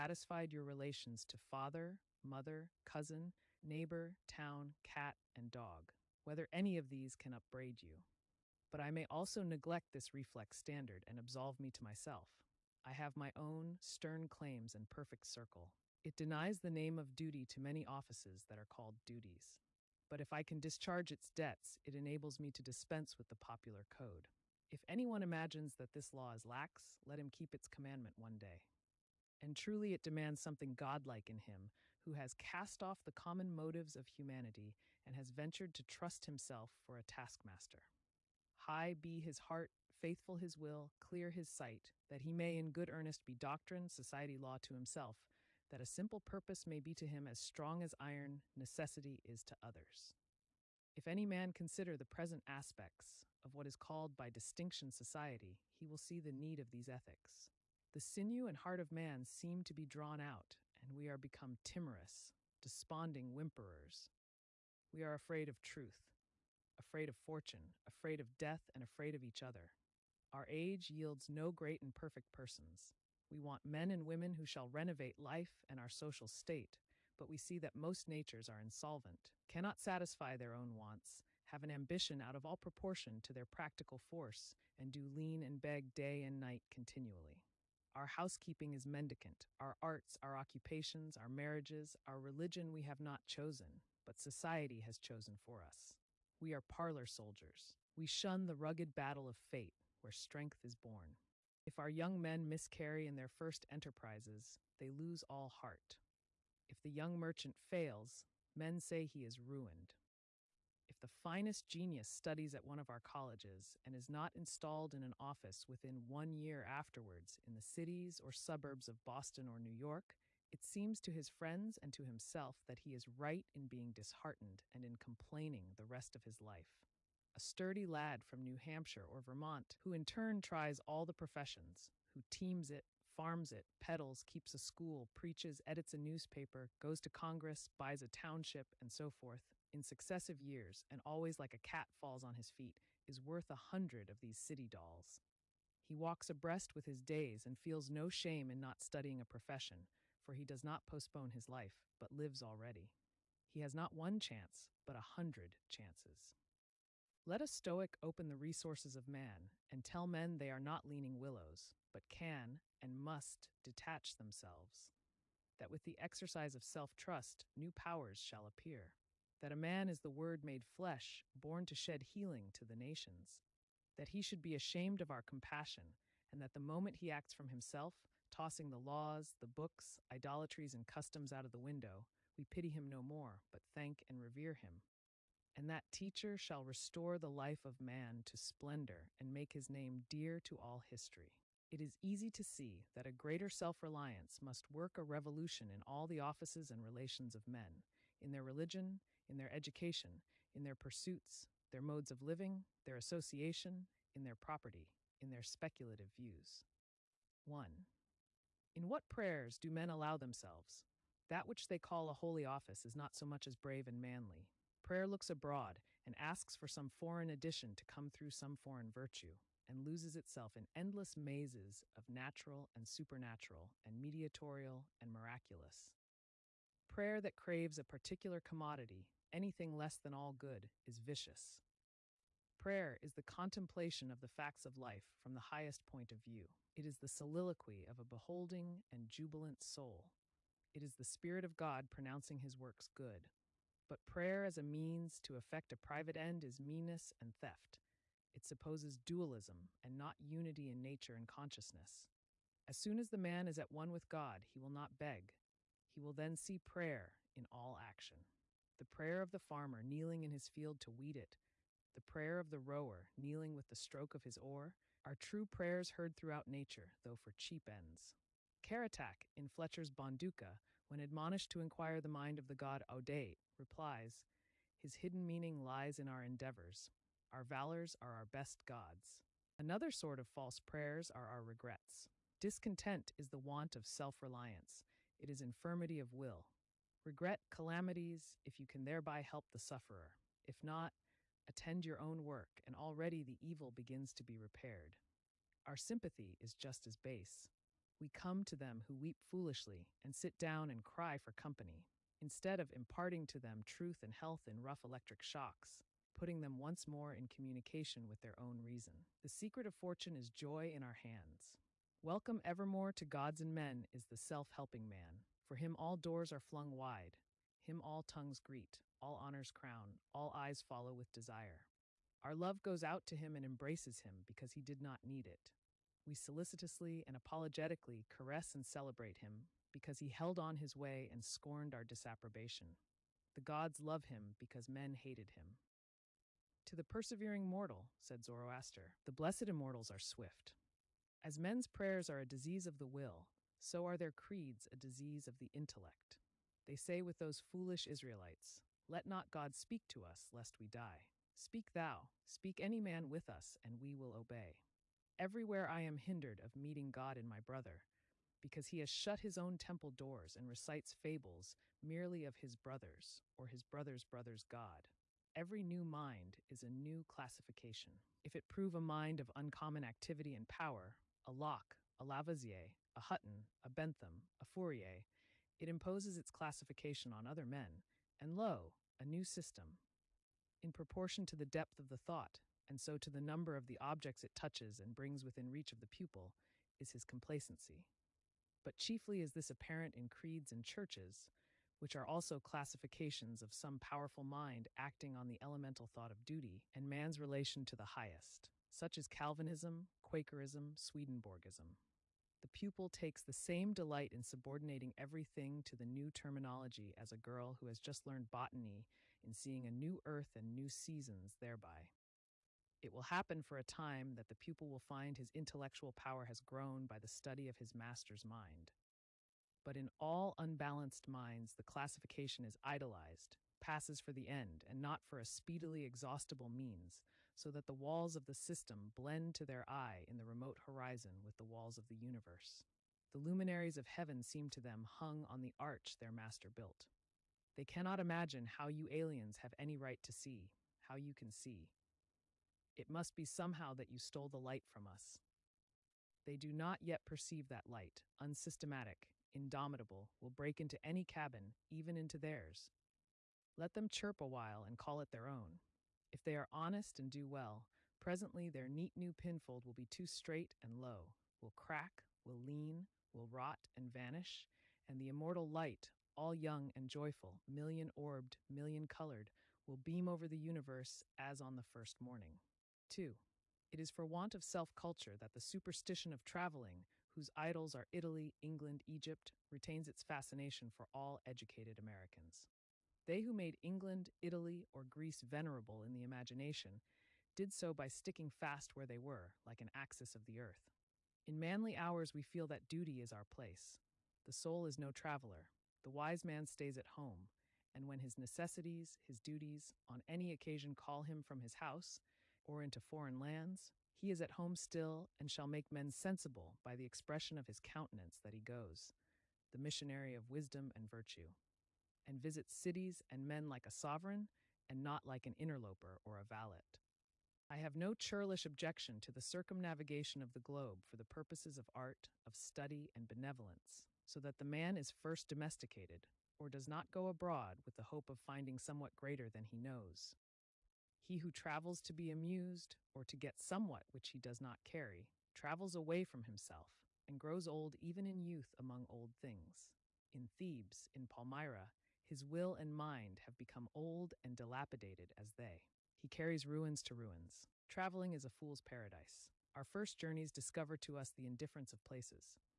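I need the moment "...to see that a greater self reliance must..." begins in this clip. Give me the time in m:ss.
3:12.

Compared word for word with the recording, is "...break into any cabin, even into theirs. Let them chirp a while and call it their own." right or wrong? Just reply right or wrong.
right.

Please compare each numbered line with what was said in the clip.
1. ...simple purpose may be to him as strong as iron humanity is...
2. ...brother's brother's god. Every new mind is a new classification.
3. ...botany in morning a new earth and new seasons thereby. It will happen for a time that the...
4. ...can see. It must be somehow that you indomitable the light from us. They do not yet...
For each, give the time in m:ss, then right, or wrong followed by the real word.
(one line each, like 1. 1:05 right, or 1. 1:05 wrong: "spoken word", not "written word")
1. 0:45 wrong: "necessity", not "humanity"
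2. 6:03 right
3. 6:48 wrong: "seeing", not "morning"
4. 7:21 wrong: "stole", not "indomitable".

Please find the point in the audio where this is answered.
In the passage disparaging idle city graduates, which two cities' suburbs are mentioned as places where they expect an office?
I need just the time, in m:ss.
1:59.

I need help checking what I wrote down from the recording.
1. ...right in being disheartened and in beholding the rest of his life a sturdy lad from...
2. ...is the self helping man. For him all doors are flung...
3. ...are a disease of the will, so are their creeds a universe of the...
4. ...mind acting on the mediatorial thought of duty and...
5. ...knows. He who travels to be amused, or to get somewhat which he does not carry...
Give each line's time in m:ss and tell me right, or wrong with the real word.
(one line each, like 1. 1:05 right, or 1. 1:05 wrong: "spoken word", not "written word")
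1. 2:03 wrong: "complaining", not "beholding"
2. 5:13 right
3. 5:42 wrong: "disease", not "universe"
4. 6:34 wrong: "elemental", not "mediatorial"
5. 8:49 right.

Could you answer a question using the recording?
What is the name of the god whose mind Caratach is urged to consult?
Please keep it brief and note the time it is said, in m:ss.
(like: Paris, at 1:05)
Audate, at 4:32.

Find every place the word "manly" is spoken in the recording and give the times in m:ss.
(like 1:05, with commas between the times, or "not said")
3:34, 8:11.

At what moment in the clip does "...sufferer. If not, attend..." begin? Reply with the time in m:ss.
4:49.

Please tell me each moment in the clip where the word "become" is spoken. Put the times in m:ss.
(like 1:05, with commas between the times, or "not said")
1:01, 9:03.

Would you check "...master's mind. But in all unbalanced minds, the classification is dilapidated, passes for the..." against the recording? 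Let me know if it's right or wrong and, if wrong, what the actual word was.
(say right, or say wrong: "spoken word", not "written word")
wrong: "idolized", not "dilapidated".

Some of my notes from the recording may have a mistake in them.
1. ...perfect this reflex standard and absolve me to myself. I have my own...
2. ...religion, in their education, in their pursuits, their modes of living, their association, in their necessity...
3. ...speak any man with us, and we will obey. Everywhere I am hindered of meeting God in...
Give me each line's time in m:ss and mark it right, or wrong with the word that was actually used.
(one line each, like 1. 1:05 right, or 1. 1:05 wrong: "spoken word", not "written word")
1. 0:09 wrong: "neglect", not "perfect"
2. 3:18 wrong: "property", not "necessity"
3. 5:52 right.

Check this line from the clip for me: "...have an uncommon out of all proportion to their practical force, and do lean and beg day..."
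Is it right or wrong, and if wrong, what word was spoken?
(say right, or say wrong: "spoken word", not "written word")
wrong: "ambition", not "uncommon".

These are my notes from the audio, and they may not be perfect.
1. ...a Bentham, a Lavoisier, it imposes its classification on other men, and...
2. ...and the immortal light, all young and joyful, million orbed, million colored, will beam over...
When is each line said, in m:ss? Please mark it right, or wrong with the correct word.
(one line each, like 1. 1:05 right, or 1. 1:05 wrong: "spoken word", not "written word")
1. 6:13 wrong: "Fourier", not "Lavoisier"
2. 7:44 right.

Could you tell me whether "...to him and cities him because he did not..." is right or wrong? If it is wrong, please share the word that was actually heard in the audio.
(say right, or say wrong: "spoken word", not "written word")
wrong: "embraces", not "cities".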